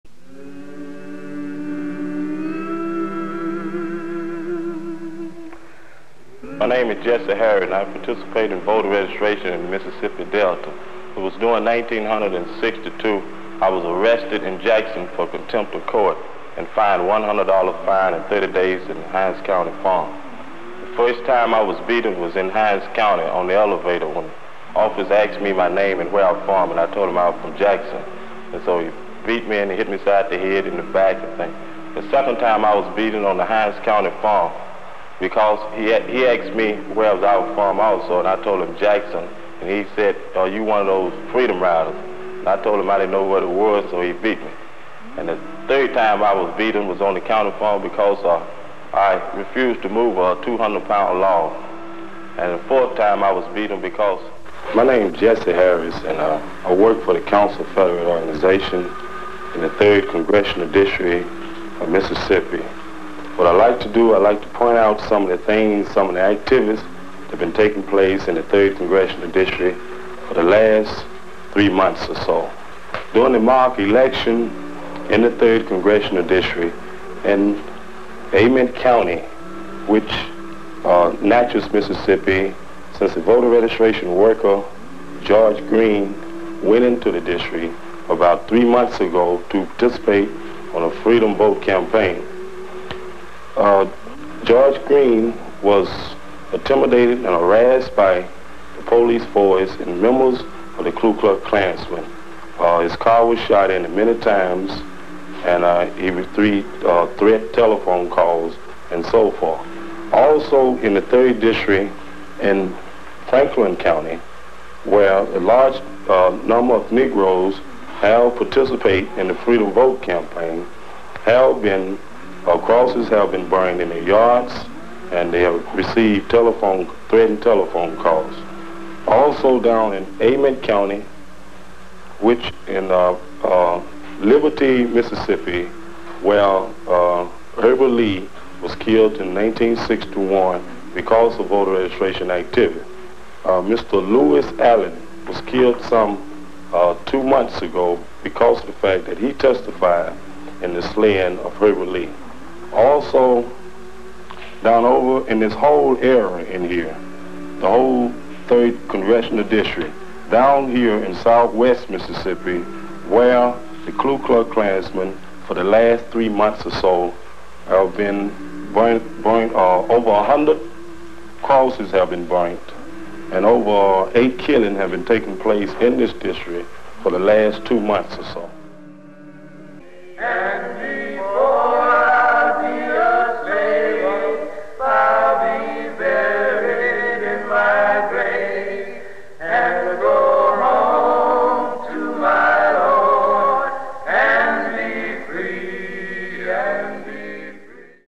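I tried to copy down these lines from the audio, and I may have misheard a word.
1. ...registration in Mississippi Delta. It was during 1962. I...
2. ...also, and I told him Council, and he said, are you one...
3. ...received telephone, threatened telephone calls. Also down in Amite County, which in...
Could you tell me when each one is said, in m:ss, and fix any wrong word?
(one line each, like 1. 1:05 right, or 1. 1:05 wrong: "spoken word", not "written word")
1. 0:08 right
2. 0:37 wrong: "Jackson", not "Council"
3. 2:05 right.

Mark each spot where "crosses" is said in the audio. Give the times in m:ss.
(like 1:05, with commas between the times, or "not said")
2:02, 2:51.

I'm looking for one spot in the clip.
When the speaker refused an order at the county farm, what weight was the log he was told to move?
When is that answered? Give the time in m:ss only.
0:50.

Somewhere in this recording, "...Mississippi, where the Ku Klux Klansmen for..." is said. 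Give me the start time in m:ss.
2:41.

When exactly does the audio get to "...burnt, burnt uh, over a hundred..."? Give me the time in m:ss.
2:48.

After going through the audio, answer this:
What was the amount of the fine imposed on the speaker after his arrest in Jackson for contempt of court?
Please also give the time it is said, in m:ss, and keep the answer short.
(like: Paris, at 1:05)
$100, at 0:17.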